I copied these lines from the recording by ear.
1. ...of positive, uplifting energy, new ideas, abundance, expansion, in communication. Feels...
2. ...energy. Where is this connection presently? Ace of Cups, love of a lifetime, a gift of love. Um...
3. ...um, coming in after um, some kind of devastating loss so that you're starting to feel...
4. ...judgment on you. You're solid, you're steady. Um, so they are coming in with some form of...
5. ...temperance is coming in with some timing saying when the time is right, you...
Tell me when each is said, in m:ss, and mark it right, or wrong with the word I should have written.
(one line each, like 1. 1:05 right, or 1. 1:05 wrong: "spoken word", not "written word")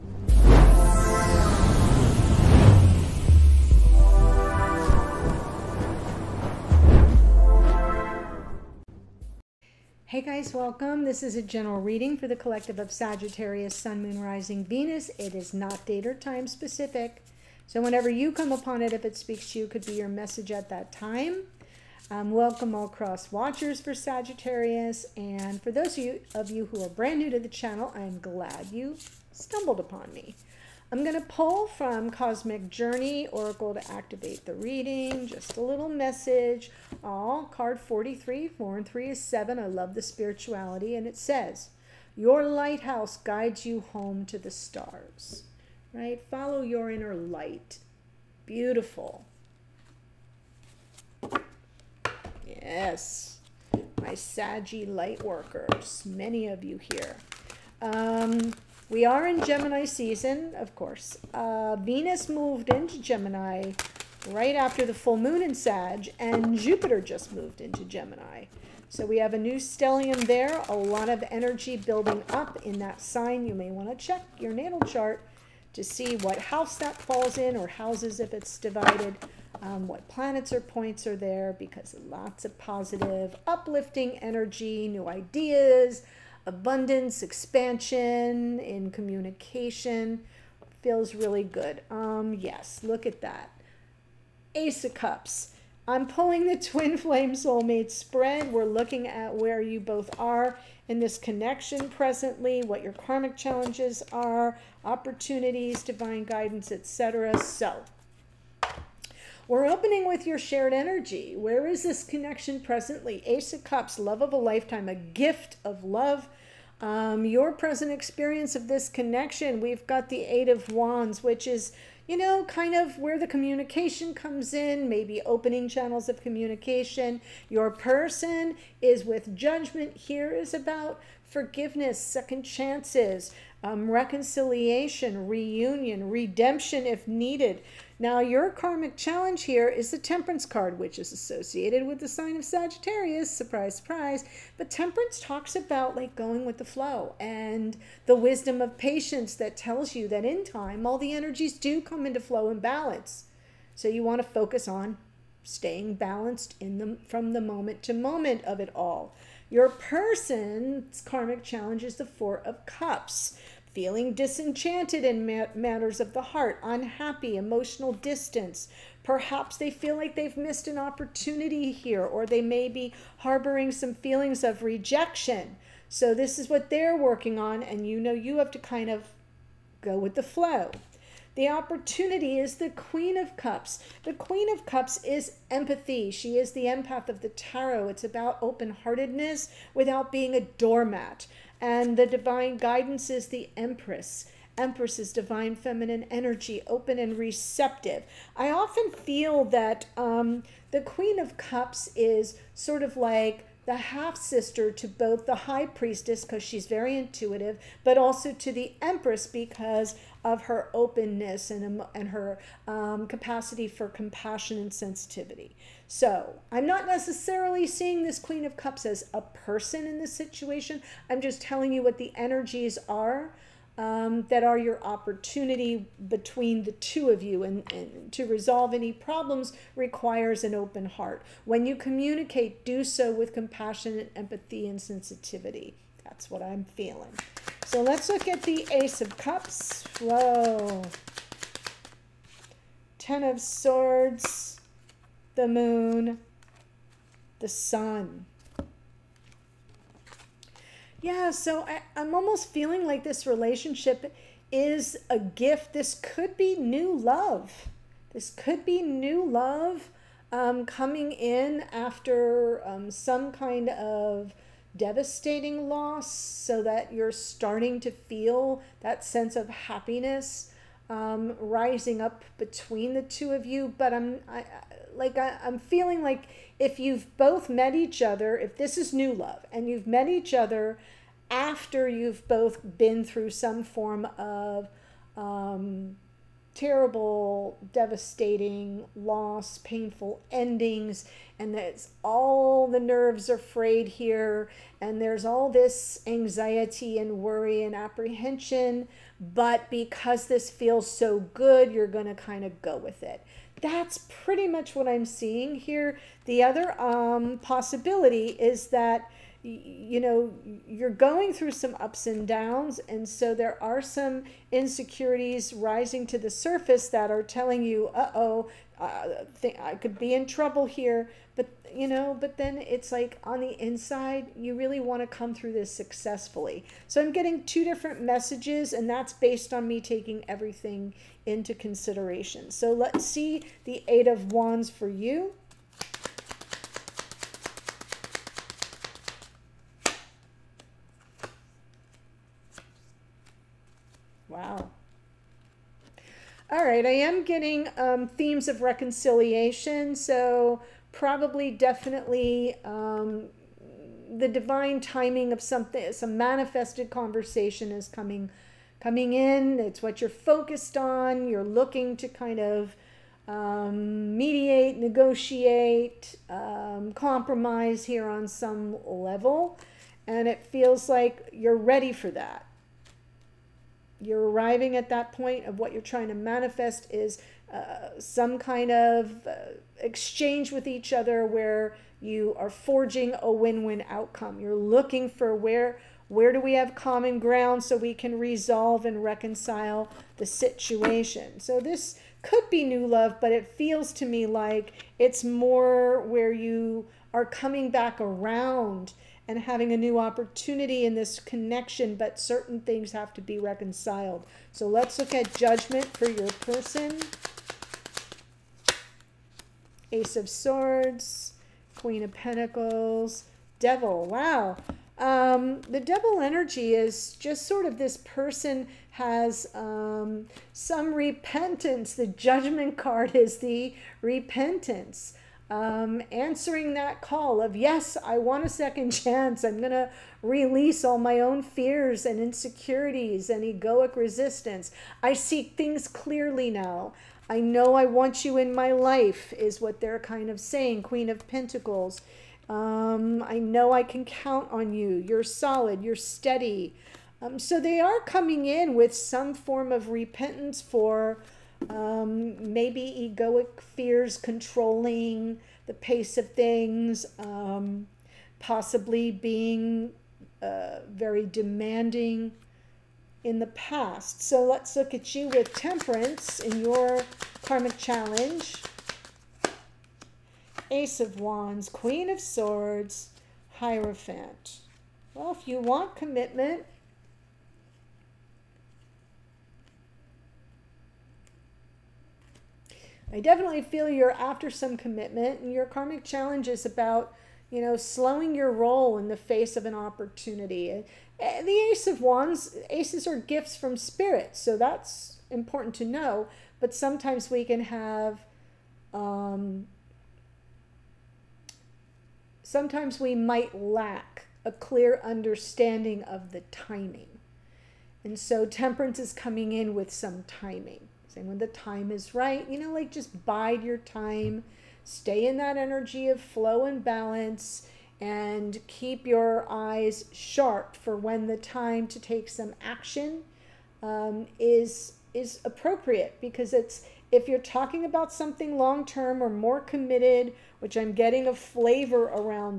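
1. 1:22 right
2. 1:50 right
3. 4:20 right
4. 7:24 wrong: "count", not "judgment"
5. 8:28 right.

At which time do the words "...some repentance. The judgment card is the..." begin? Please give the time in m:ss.
7:00.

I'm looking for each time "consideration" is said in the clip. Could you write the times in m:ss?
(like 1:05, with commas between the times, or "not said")
5:31.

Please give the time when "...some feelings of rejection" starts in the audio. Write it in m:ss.
2:53.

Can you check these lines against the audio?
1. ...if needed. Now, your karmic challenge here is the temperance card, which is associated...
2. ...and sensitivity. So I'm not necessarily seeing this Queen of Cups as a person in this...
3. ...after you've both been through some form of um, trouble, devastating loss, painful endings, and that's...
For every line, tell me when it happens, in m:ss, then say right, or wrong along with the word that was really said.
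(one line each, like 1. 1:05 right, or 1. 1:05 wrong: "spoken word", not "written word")
1. 2:16 right
2. 3:34 right
3. 4:41 wrong: "terrible", not "trouble".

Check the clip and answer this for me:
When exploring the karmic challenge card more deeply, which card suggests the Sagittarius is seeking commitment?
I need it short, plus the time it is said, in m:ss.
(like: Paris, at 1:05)
Hierophant, at 7:53.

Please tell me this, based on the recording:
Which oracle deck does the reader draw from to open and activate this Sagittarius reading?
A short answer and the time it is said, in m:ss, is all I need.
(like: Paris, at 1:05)
Cosmic Journey Oracle, at 0:32.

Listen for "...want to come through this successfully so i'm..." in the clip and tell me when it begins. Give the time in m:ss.
5:24.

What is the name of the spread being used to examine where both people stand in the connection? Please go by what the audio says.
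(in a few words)
twin flame soulmate spread.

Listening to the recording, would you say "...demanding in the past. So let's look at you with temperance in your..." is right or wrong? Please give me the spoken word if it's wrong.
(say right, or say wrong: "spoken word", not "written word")
right.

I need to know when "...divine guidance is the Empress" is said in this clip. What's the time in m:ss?
3:12.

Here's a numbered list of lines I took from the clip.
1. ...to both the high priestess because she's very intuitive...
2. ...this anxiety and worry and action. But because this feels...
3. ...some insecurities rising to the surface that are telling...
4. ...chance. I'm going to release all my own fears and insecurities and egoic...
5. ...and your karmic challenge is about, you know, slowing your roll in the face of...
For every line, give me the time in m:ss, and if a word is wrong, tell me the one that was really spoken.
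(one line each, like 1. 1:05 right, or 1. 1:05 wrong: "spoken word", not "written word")
1. 3:24 right
2. 4:55 wrong: "apprehension", not "action"
3. 5:13 right
4. 7:08 right
5. 8:05 right.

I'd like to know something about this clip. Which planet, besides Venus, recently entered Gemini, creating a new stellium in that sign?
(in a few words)
Jupiter.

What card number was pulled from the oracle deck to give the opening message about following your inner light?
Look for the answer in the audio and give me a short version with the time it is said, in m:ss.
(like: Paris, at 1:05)
43, at 0:37.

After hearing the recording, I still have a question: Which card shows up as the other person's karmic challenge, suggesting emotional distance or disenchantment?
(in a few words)
Four of Cups.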